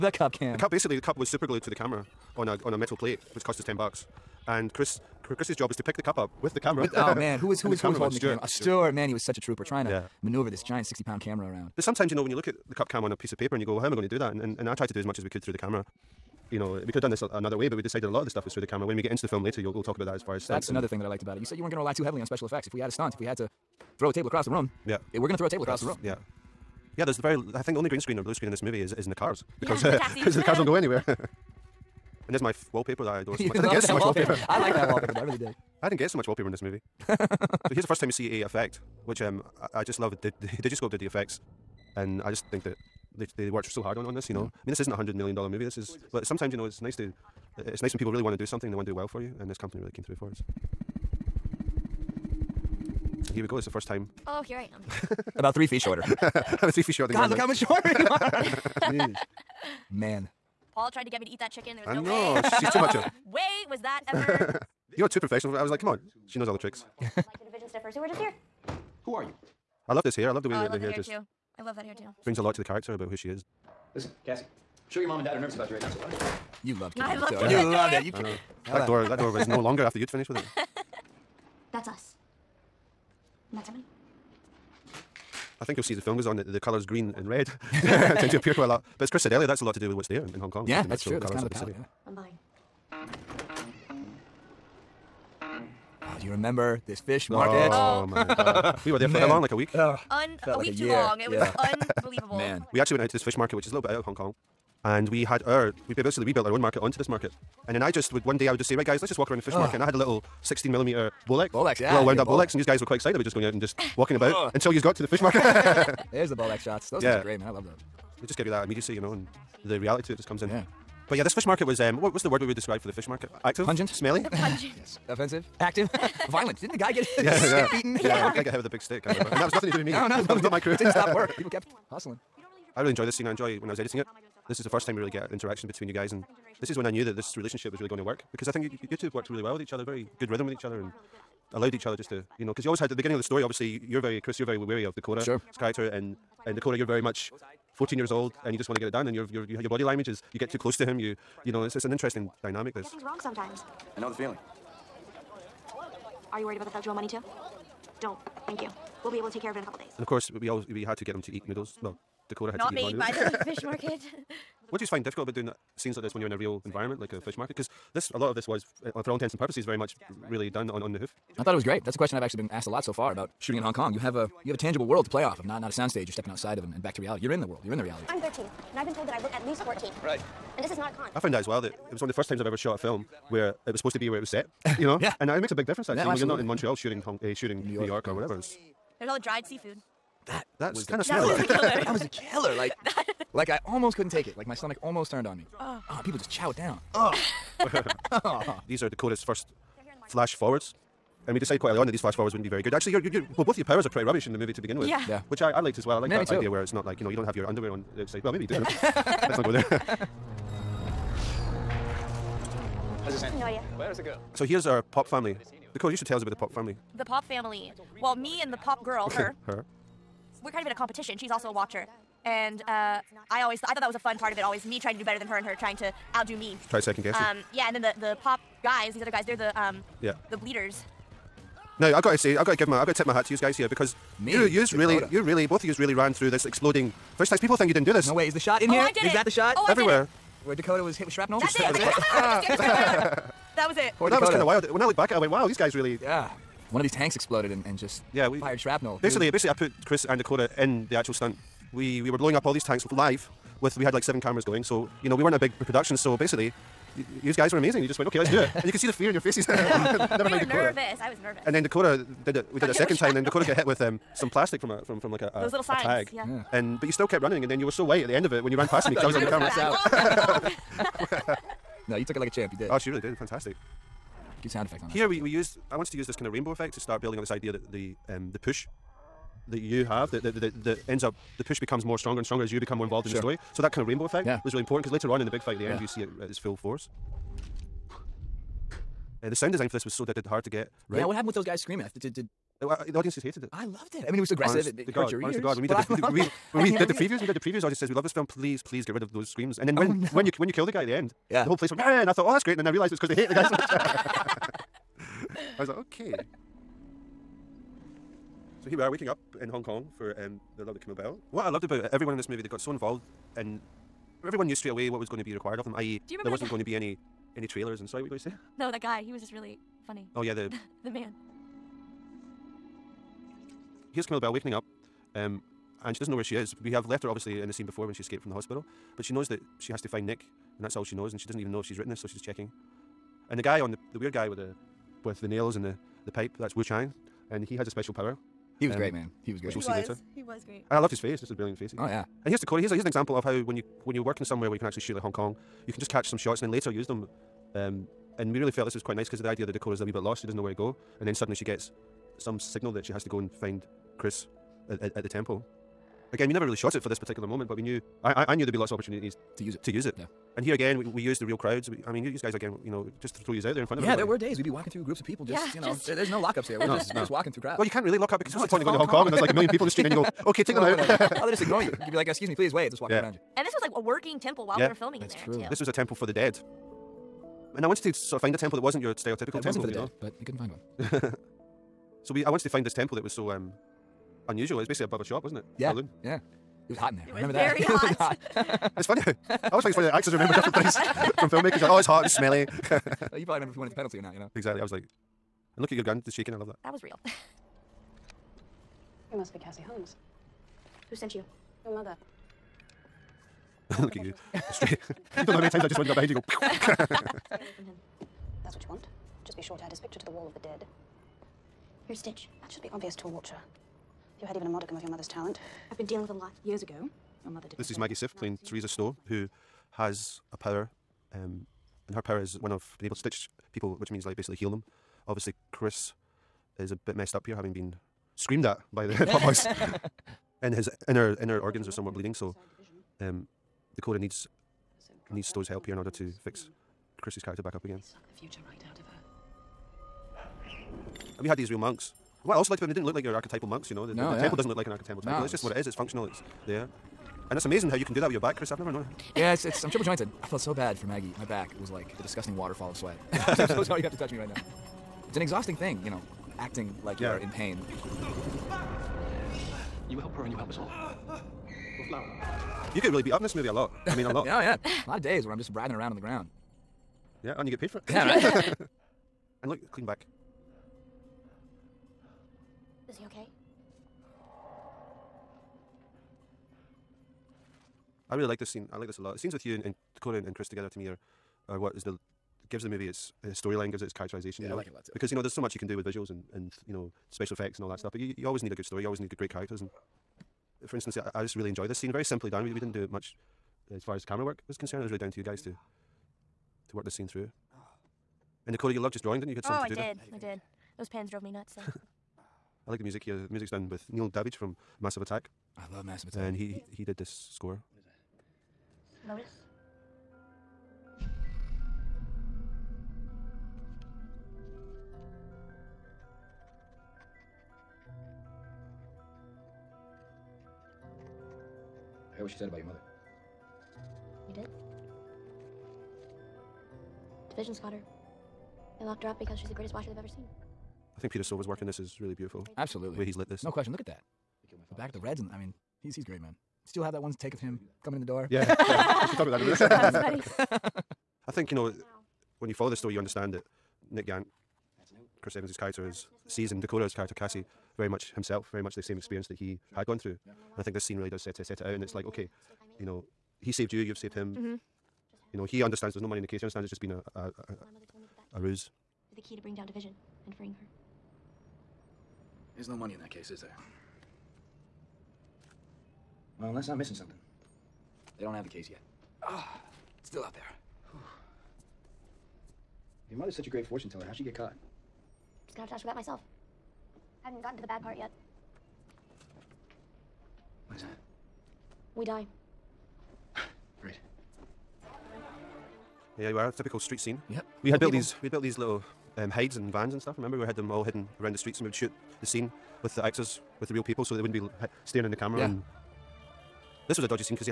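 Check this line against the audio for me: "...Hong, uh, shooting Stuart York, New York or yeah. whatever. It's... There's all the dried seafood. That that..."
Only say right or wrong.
wrong.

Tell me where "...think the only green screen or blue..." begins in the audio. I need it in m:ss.
0:27.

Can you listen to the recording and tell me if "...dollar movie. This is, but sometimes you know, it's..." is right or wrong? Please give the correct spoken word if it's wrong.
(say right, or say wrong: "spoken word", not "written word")
right.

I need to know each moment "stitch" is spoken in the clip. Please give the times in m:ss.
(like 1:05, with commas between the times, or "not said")
6:51, 7:02.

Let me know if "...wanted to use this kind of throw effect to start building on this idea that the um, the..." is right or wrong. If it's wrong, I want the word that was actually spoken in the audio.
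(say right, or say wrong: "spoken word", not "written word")
wrong: "rainbow", not "throw".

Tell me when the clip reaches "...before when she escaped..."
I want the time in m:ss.
5:27.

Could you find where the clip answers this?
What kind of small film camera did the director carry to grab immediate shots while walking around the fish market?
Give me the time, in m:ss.
1:50.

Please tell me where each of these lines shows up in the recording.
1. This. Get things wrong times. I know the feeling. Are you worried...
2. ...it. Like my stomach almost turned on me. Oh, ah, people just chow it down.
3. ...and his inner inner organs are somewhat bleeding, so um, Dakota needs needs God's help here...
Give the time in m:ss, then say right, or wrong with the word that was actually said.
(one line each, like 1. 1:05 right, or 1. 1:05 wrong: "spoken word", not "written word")
1. 2:32 wrong: "sometimes", not "times"
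2. 3:14 right
3. 7:10 wrong: "Stowe", not "God".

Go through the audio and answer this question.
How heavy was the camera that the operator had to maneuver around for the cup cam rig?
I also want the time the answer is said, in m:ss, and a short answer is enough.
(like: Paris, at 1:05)
60 pounds, at 0:10.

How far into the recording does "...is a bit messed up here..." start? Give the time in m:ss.
7:06.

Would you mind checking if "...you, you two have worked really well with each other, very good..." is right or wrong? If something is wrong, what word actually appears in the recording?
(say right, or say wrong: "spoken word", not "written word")
right.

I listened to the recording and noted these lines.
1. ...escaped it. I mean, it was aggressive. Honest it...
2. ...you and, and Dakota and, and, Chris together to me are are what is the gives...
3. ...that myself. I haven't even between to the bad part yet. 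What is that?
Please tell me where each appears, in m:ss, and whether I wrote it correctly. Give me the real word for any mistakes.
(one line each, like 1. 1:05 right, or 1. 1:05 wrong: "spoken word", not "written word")
1. 4:53 wrong: "loved", not "escaped"
2. 7:59 right
3. 9:35 wrong: "gotten", not "between".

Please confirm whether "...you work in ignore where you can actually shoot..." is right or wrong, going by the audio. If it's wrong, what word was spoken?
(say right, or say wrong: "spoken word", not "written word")
wrong: "somewhere", not "ignore".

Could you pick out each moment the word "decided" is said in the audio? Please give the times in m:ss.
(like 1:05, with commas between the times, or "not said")
0:17, 3:21.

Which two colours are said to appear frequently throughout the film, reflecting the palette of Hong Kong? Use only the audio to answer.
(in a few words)
Green and red.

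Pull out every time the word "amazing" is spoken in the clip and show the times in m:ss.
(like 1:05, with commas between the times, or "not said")
4:17, 7:27.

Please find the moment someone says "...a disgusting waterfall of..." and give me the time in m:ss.
7:31.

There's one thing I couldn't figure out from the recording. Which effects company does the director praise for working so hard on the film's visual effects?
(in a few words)
Digiscope.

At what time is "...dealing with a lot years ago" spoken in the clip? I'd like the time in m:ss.
6:55.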